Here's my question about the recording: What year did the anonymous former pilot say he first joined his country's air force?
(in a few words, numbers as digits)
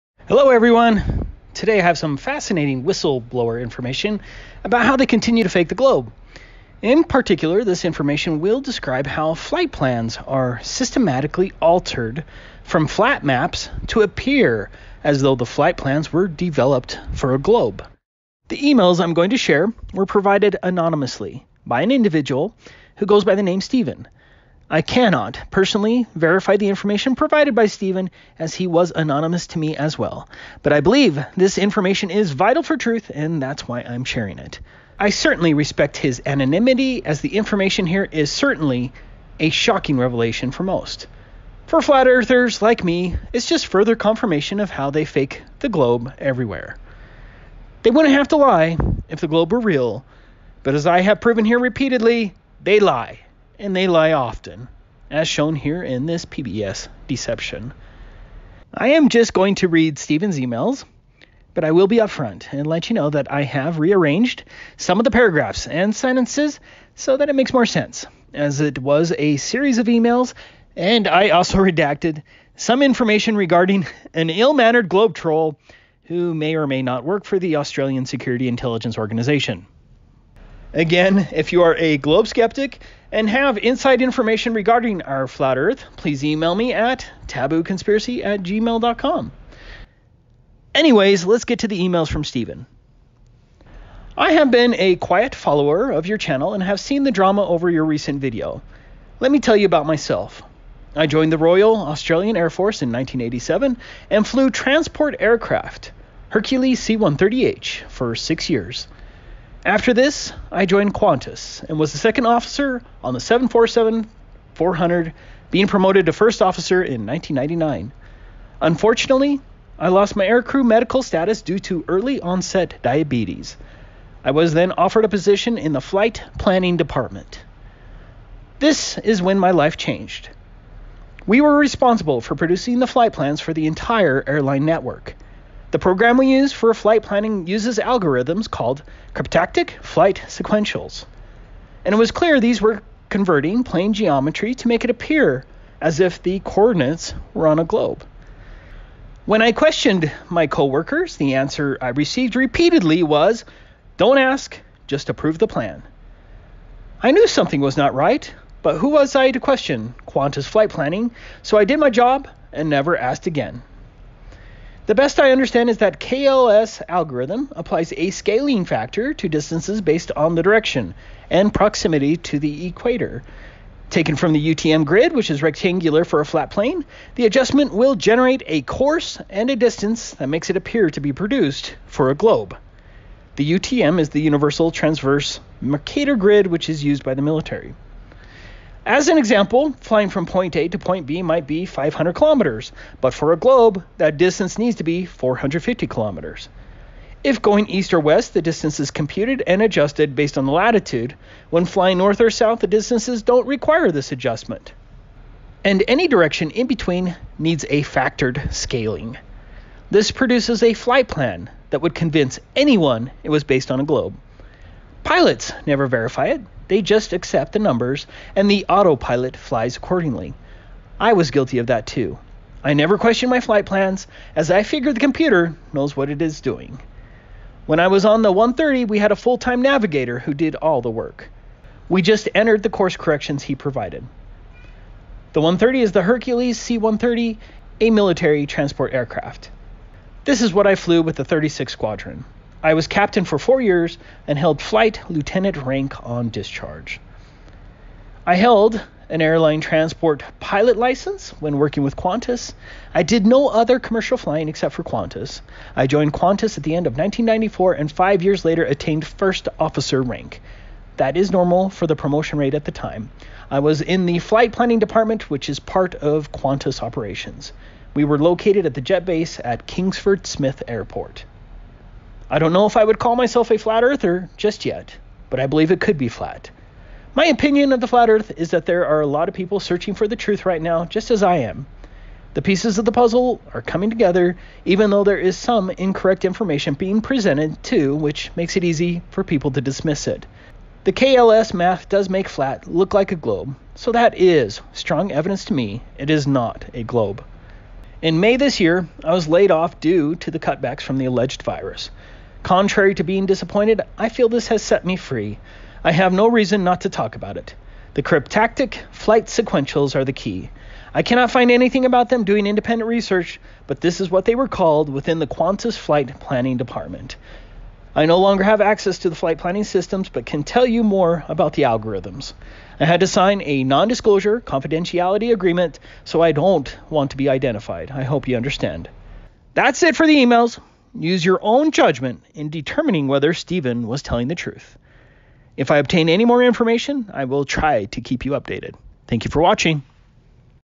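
1987.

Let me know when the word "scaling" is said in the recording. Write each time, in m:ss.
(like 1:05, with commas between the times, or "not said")
2:48, 3:28.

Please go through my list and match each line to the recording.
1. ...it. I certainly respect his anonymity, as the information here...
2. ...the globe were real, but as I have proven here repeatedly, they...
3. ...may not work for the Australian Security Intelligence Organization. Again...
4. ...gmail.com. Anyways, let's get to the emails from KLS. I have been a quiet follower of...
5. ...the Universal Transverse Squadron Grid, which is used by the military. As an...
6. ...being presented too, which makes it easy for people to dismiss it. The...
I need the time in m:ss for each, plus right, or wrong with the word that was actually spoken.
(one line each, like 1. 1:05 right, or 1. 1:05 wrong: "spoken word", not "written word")
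1. 0:34 right
2. 0:49 right
3. 1:16 right
4. 1:28 wrong: "Stephen", not "KLS"
5. 3:04 wrong: "Mercator", not "Squadron"
6. 4:46 right.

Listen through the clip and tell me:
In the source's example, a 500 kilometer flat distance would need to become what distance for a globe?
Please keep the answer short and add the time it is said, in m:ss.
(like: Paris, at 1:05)
450 kilometers, at 3:15.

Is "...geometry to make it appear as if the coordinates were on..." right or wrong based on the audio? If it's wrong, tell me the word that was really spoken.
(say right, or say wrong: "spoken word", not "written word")
right.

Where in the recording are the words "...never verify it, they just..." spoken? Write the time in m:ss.
3:35.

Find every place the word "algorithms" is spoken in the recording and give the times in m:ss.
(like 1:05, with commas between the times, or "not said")
2:17, 2:46, 5:21.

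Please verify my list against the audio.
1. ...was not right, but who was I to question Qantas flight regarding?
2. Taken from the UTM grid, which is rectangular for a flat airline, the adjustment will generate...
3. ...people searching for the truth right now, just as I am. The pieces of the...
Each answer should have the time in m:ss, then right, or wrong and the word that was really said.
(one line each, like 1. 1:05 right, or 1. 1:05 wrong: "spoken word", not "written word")
1. 2:37 wrong: "planning", not "regarding"
2. 2:53 wrong: "plane", not "airline"
3. 4:39 right.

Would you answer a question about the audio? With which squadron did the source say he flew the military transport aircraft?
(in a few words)
36 Squadron.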